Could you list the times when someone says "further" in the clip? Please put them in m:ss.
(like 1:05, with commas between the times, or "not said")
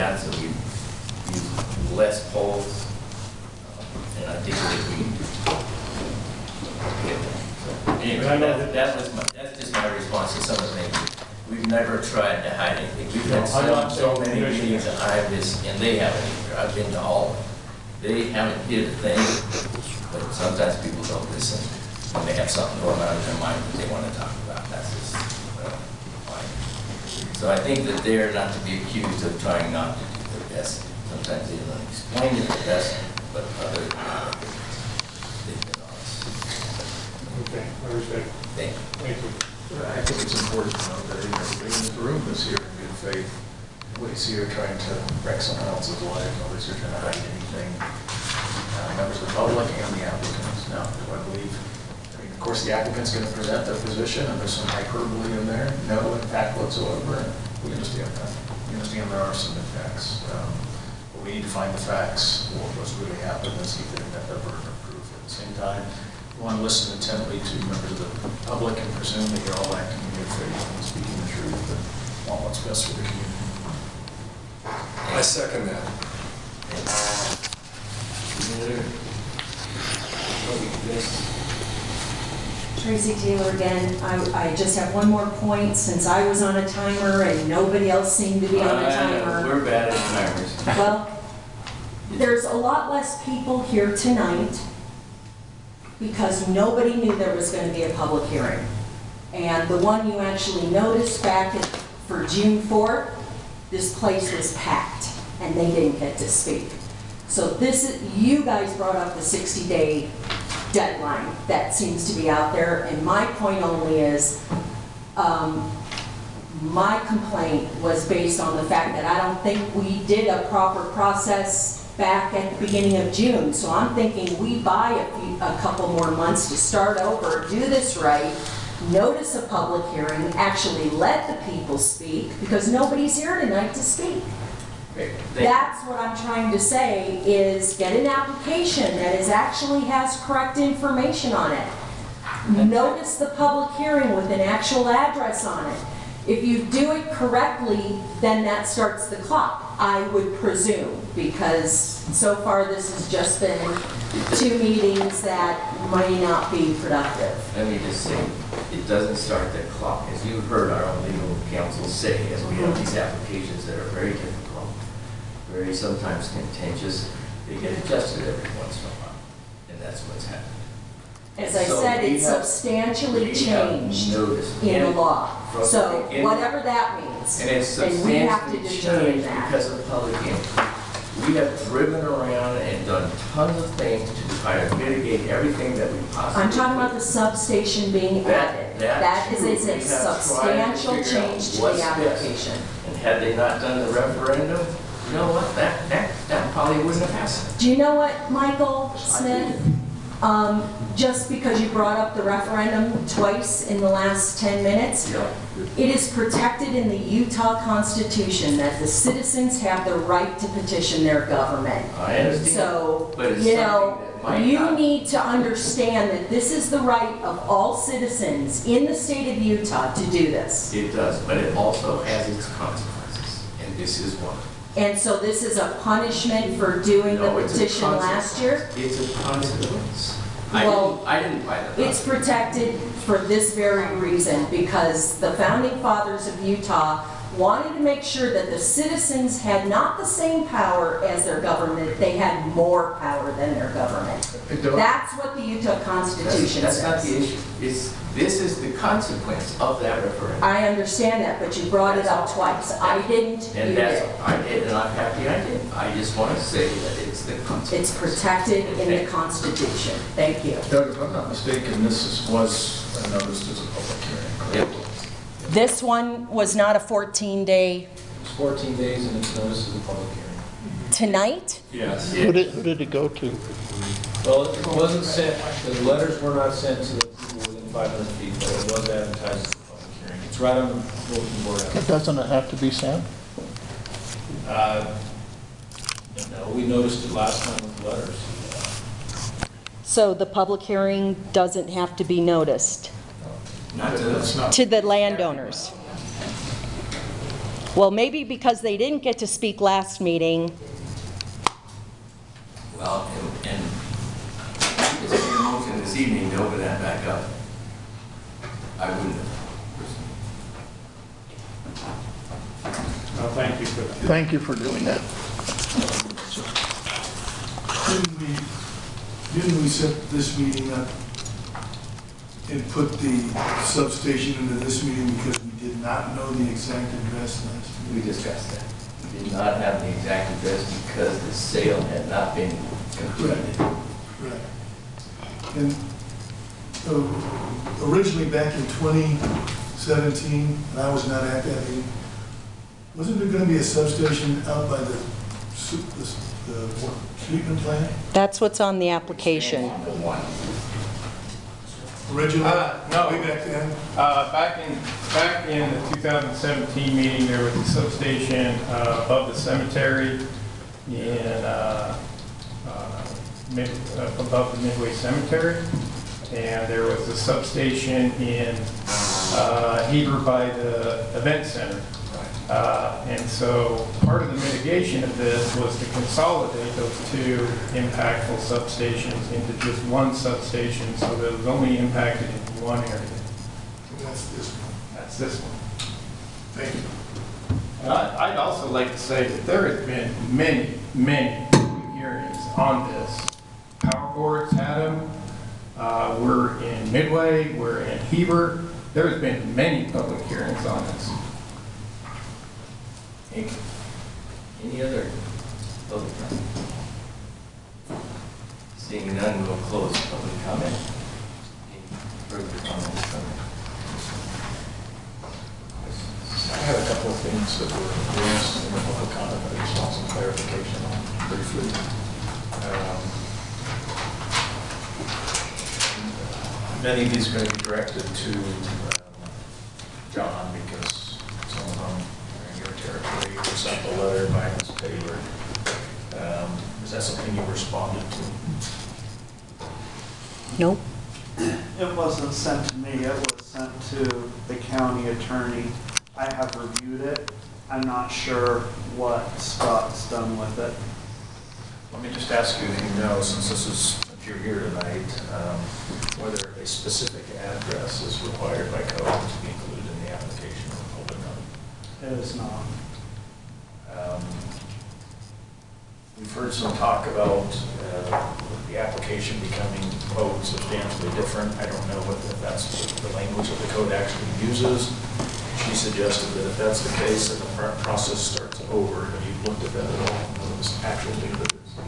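6:52.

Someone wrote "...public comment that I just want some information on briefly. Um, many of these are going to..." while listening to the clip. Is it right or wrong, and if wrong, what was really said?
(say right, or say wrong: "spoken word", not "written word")
wrong: "clarification", not "information".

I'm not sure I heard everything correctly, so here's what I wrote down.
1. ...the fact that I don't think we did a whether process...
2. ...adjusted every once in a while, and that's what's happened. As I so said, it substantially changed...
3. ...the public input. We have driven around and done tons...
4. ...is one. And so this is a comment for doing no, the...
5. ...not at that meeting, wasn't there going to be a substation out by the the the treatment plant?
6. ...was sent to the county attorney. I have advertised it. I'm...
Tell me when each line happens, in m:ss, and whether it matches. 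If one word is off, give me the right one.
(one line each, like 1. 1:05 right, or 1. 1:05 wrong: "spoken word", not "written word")
1. 1:58 wrong: "proper", not "whether"
2. 2:47 right
3. 2:59 right
4. 3:44 wrong: "punishment", not "comment"
5. 5:41 right
6. 7:23 wrong: "reviewed", not "advertised".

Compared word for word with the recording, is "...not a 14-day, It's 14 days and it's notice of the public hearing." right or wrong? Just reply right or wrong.
right.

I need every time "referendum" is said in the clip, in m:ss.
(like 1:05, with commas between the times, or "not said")
3:13, 3:22, 4:10.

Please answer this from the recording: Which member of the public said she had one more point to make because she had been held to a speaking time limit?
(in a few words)
Tracy Taylor.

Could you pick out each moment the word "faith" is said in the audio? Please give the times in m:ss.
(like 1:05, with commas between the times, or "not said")
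0:43, 1:10.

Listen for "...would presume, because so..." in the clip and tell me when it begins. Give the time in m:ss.
2:30.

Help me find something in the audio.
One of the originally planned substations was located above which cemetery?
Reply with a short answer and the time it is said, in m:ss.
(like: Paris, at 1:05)
Midway Cemetery, at 6:04.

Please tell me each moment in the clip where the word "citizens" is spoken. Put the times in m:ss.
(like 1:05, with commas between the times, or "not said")
3:28, 3:37, 3:58.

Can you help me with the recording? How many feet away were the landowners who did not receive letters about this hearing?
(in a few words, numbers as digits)
500.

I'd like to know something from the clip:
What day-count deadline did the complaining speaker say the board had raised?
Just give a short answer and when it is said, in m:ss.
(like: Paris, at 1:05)
60 day, at 1:49.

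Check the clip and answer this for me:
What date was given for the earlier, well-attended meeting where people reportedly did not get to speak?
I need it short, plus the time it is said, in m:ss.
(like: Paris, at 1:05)
June 4th, at 1:42.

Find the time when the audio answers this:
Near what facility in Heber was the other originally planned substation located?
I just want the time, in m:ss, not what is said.
6:11.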